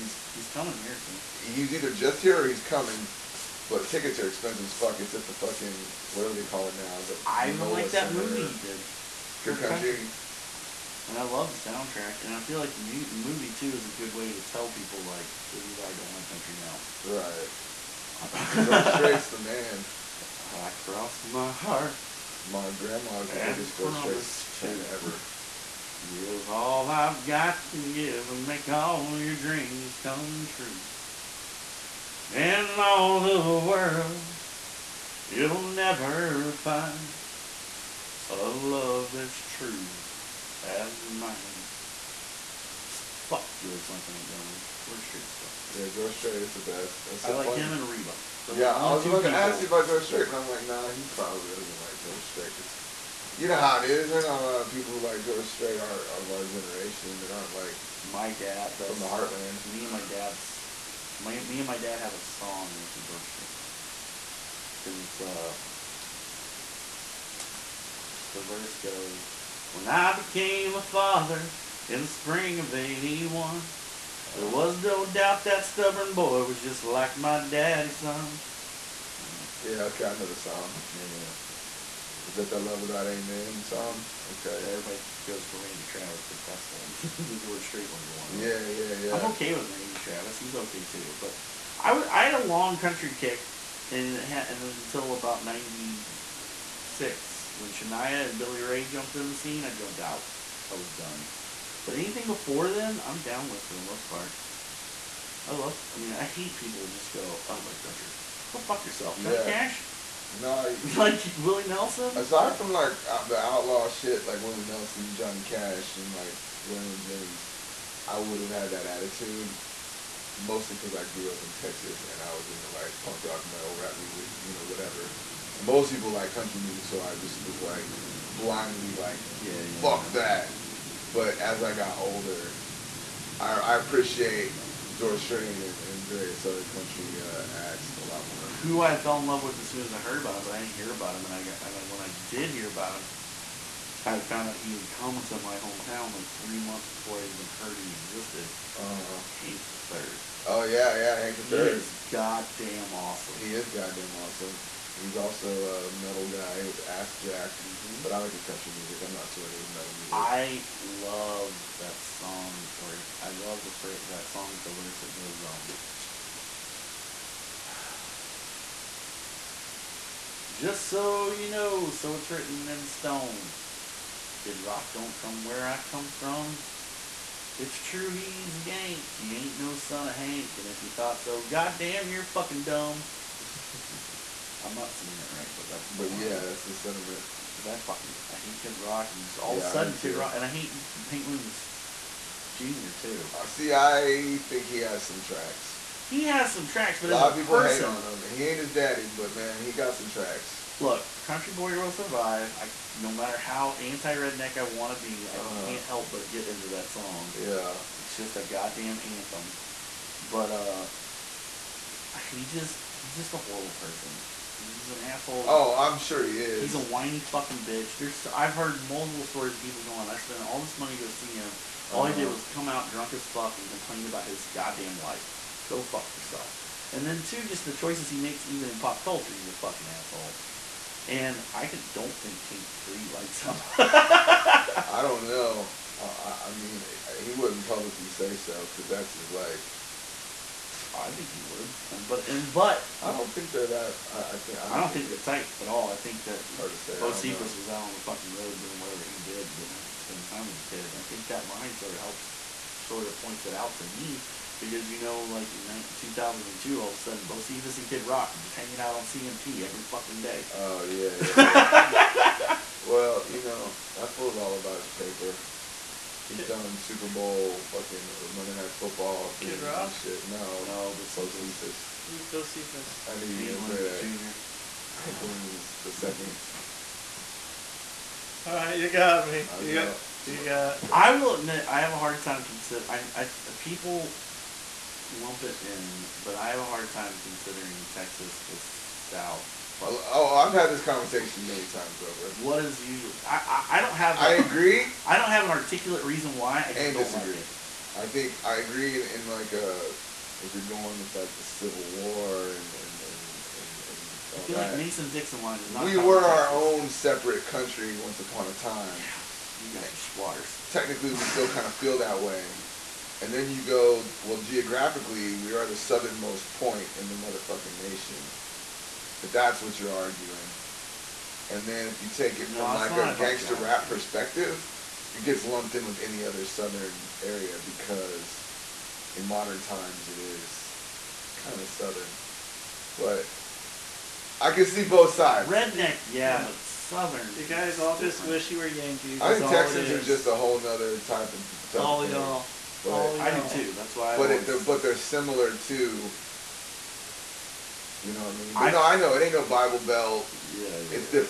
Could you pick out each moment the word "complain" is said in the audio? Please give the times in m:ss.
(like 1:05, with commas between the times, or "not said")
3:43.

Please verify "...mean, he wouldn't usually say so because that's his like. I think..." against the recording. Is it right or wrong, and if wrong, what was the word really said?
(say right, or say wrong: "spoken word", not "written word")
wrong: "publicly", not "usually".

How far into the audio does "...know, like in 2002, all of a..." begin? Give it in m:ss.
4:14.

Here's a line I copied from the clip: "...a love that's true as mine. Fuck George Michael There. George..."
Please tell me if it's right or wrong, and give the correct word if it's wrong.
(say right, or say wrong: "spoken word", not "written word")
wrong: "Montgomery", not "There".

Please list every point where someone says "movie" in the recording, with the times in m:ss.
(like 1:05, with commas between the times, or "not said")
0:08, 0:12.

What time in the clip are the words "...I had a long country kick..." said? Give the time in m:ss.
1:32.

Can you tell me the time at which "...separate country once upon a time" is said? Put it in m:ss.
5:06.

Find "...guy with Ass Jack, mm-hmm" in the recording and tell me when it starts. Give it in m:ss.
2:36.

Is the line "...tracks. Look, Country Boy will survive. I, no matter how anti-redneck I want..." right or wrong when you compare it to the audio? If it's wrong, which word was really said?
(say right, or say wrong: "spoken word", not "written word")
right.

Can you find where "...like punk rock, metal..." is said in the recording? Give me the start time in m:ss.
2:02.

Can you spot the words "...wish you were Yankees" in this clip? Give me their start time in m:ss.
5:38.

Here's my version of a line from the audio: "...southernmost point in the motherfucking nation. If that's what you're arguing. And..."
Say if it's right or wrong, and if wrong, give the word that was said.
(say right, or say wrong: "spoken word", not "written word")
right.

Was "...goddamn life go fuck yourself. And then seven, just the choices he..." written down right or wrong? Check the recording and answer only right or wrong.
wrong.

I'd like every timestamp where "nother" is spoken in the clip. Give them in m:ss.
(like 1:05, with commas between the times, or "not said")
5:40.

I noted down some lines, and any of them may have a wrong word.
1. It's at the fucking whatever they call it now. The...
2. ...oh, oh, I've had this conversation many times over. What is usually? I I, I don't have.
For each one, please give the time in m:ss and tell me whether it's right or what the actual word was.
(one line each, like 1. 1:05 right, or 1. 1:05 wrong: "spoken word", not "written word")
1. 0:04 right
2. 4:49 right.